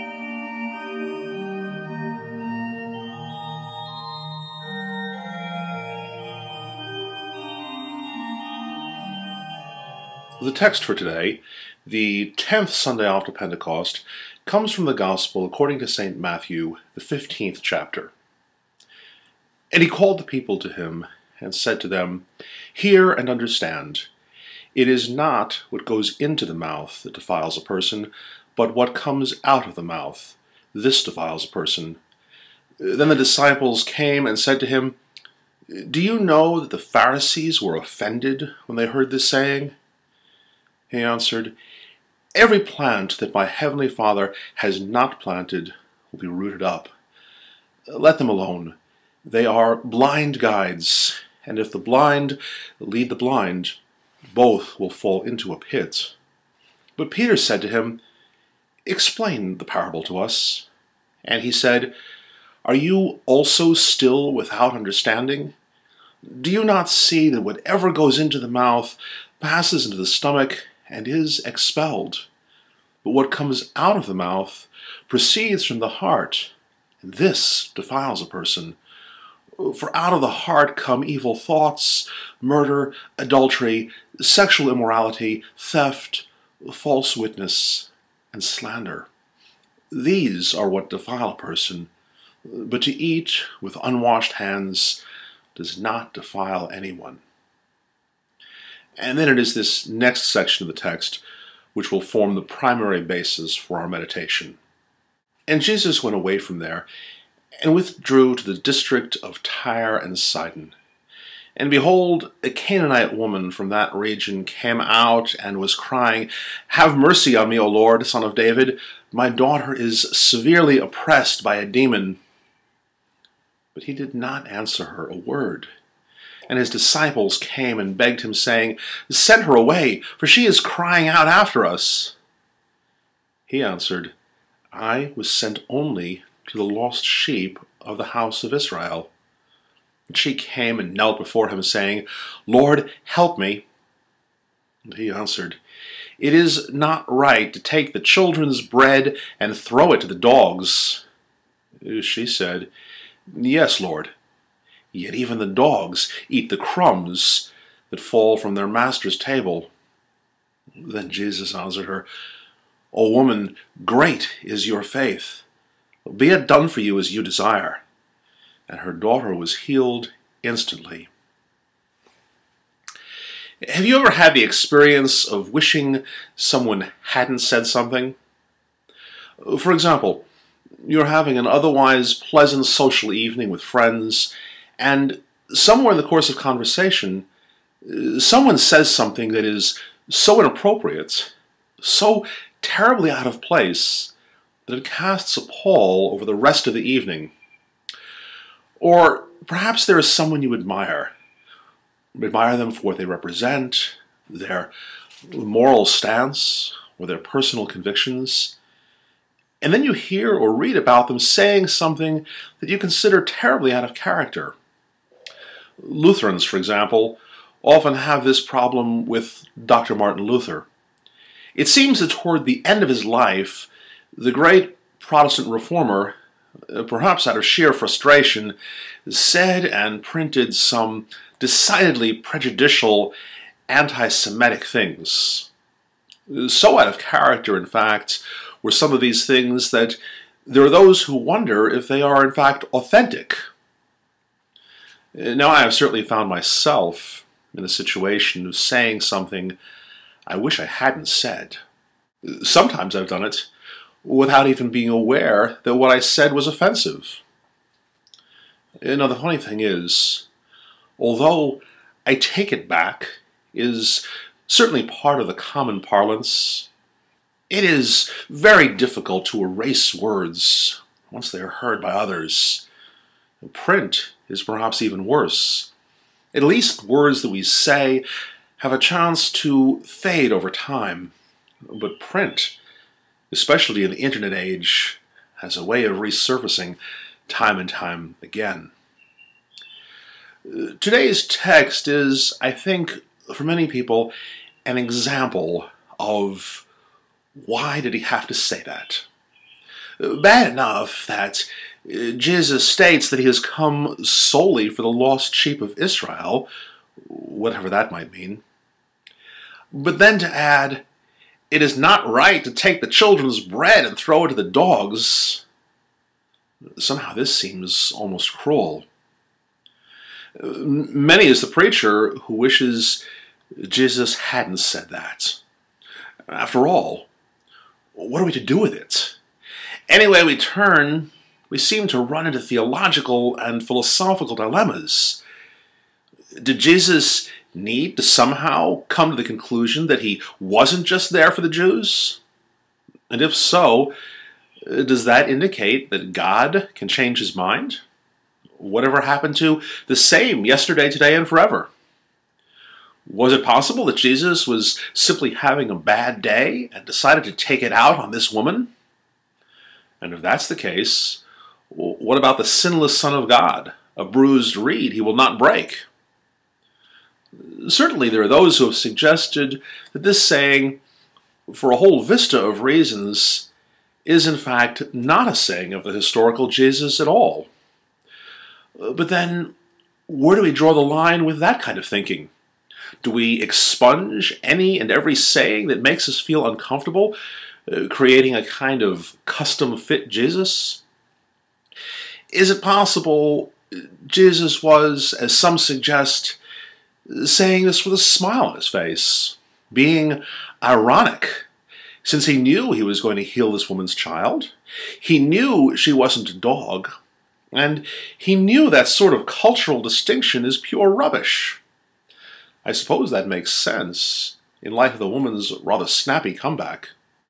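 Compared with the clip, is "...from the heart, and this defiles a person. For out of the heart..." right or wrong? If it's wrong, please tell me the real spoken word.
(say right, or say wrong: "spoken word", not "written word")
right.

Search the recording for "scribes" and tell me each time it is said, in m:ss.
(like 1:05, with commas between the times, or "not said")
not said.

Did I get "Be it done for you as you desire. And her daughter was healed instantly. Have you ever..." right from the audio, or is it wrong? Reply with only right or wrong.
right.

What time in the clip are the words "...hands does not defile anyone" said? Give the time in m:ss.
1:34.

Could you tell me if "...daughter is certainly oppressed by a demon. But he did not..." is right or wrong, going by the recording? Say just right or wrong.
wrong.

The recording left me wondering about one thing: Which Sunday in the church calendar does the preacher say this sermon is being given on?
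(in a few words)
10th Sunday after Pentecost.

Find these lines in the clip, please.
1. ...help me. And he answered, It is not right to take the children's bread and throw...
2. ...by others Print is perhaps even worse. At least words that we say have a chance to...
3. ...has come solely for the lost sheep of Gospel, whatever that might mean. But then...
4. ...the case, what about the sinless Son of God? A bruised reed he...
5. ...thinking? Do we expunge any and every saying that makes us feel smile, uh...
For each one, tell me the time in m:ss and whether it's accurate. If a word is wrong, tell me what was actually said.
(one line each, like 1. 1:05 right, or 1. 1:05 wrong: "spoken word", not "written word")
1. 2:23 right
2. 4:31 right
3. 5:03 wrong: "Israel", not "Gospel"
4. 6:00 right
5. 6:21 wrong: "uncomfortable", not "smile".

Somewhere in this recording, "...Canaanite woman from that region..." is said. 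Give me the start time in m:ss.
1:52.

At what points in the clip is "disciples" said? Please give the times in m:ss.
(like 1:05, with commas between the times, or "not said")
0:33, 2:06.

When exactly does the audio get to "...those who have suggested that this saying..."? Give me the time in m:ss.
6:08.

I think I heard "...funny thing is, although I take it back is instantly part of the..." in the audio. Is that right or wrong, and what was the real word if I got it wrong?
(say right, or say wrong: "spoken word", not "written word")
wrong: "certainly", not "instantly".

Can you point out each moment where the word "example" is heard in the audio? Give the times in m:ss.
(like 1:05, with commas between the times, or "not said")
2:59, 3:36, 4:54.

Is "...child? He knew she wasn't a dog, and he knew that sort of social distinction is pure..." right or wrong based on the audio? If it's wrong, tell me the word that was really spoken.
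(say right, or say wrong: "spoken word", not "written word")
wrong: "cultural", not "social".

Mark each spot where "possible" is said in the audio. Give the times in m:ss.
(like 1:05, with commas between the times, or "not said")
5:53, 6:32.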